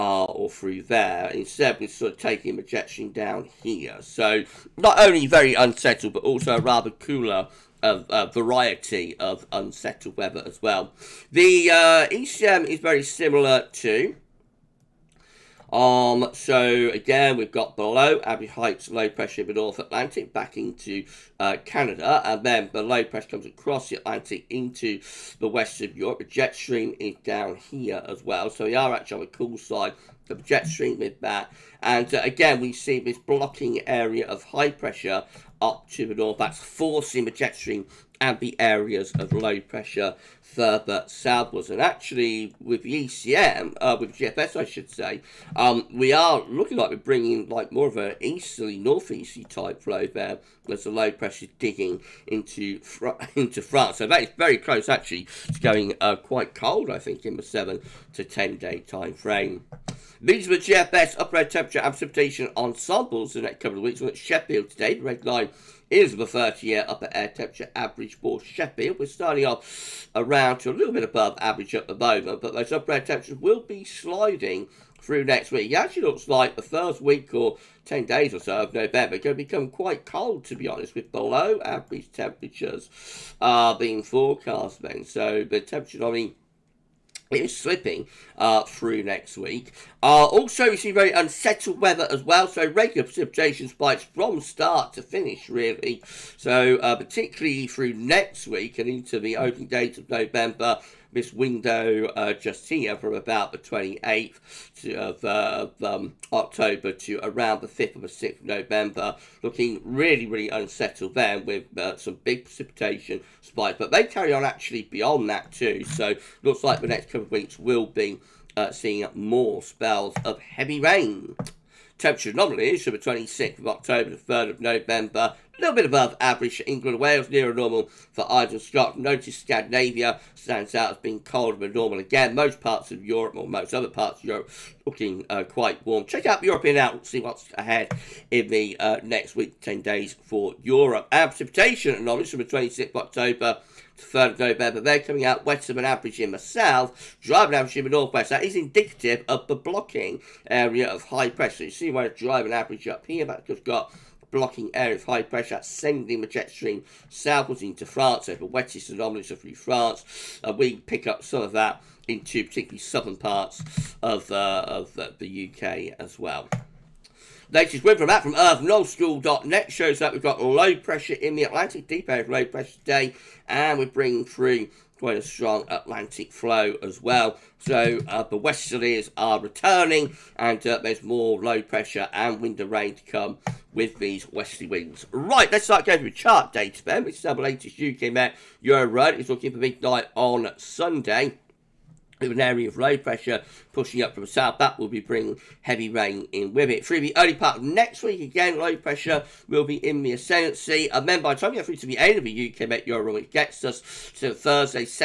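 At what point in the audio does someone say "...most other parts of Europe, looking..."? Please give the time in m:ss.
2:13.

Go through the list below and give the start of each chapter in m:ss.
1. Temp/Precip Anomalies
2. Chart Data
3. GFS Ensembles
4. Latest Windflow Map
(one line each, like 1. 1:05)
1. 2:01
2. 3:05
3. 0:59
4. 2:46.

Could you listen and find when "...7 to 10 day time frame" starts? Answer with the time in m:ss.
0:57.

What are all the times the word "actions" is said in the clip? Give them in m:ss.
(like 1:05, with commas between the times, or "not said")
not said.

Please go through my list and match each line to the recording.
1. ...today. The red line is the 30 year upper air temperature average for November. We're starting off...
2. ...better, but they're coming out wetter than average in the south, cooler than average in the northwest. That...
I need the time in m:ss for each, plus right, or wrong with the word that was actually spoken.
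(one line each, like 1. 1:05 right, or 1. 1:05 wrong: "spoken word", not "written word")
1. 1:04 wrong: "Sheffield", not "November"
2. 2:24 wrong: "drier", not "cooler".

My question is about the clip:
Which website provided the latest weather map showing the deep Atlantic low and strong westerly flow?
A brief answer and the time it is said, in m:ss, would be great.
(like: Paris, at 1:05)
earth.nullschool.net, at 2:48.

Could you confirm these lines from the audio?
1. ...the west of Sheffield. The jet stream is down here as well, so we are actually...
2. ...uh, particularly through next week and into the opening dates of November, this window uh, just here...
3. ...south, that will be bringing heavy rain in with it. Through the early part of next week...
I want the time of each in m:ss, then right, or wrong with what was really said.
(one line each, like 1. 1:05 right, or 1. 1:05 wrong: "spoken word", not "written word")
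1. 0:25 wrong: "Europe", not "Sheffield"
2. 1:36 right
3. 3:14 right.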